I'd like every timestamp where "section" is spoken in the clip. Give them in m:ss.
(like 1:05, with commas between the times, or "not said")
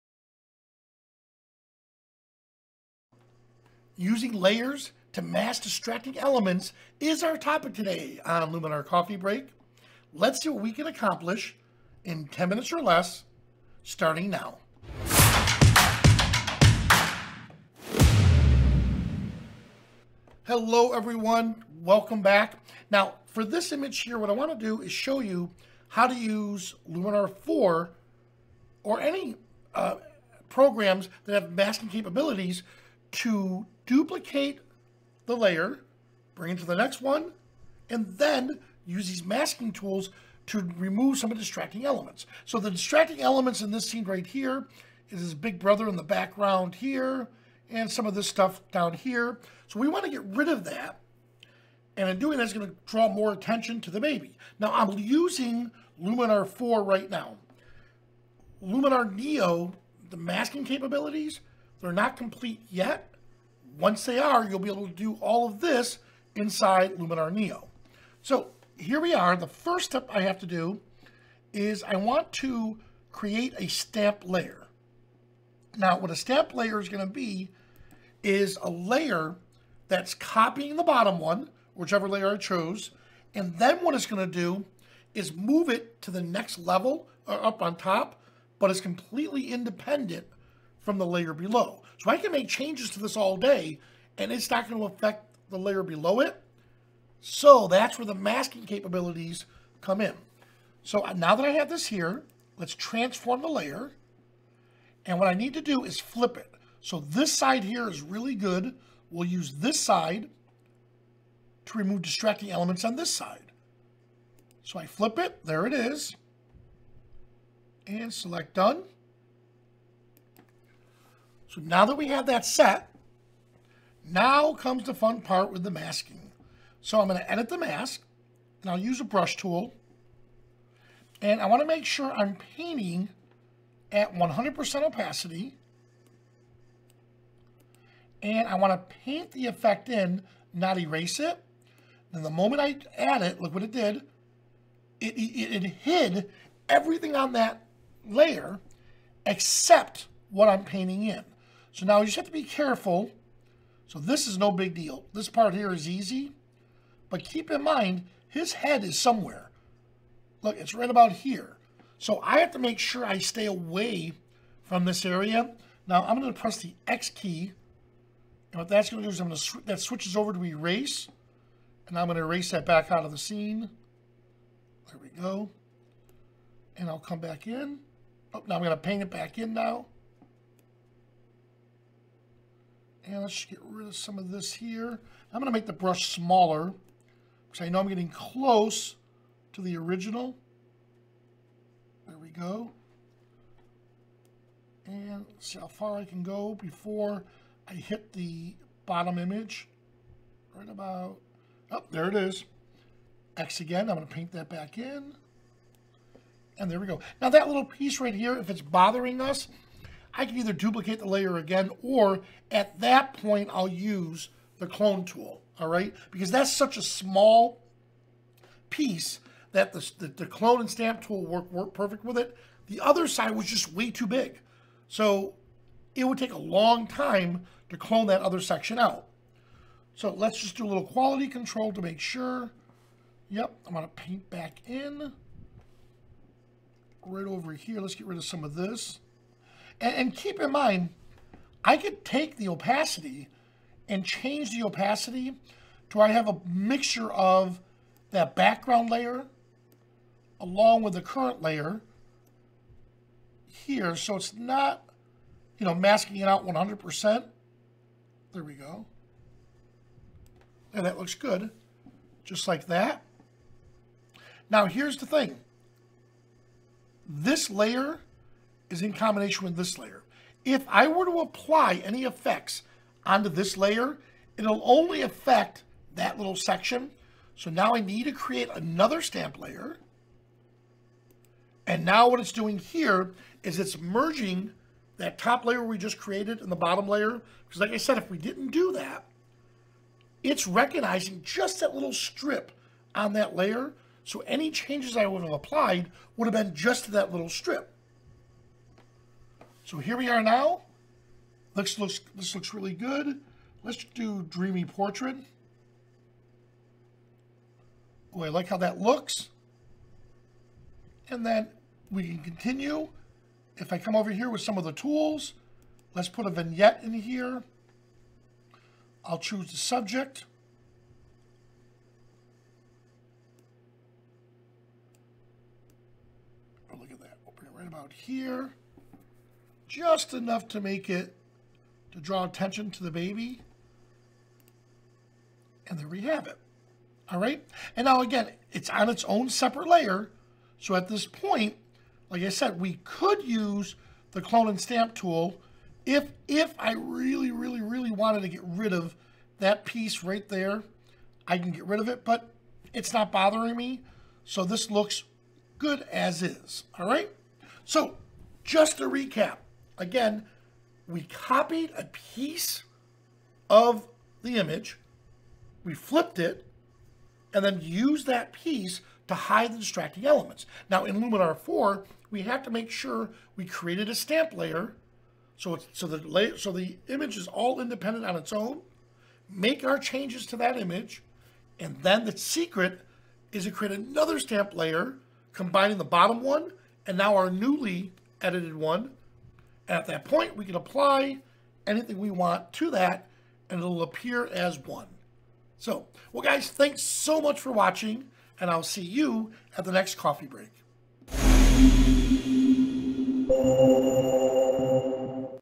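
3:48, 4:36.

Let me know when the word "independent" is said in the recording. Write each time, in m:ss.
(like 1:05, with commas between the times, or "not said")
1:29, 6:17.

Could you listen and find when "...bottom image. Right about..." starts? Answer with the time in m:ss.
3:18.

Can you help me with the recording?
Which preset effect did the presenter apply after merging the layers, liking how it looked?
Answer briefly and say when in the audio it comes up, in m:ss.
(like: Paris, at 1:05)
Dreamy Portrait, at 5:04.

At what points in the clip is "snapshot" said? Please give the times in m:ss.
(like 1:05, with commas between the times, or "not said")
not said.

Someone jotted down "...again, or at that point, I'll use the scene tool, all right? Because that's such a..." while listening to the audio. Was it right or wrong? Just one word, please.
wrong.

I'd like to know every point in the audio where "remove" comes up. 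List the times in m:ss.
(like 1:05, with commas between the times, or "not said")
0:40, 1:51.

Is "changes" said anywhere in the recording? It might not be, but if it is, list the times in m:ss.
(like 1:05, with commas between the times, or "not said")
1:32, 4:04, 4:54, 6:19.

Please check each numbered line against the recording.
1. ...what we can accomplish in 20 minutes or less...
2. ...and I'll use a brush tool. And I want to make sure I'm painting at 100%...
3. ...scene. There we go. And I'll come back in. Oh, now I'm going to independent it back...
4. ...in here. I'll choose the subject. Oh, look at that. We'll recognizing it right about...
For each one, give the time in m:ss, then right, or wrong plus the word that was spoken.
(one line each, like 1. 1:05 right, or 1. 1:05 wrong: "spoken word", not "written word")
1. 0:10 wrong: "10", not "20"
2. 2:08 right
3. 2:53 wrong: "paint", not "independent"
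4. 5:16 wrong: "bring", not "recognizing".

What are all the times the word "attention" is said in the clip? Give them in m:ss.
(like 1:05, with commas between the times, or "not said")
0:53, 5:32.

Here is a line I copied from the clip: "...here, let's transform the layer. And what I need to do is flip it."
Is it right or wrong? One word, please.
right.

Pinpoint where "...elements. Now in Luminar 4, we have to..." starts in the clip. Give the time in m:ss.
6:10.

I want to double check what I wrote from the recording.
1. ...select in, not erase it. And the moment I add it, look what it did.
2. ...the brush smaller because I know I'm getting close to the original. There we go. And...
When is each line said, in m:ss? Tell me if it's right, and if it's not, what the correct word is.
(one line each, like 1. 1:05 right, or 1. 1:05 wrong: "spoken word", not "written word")
1. 2:19 wrong: "effect", not "select"
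2. 3:05 right.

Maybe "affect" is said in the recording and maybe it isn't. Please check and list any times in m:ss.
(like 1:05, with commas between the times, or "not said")
1:34, 4:35.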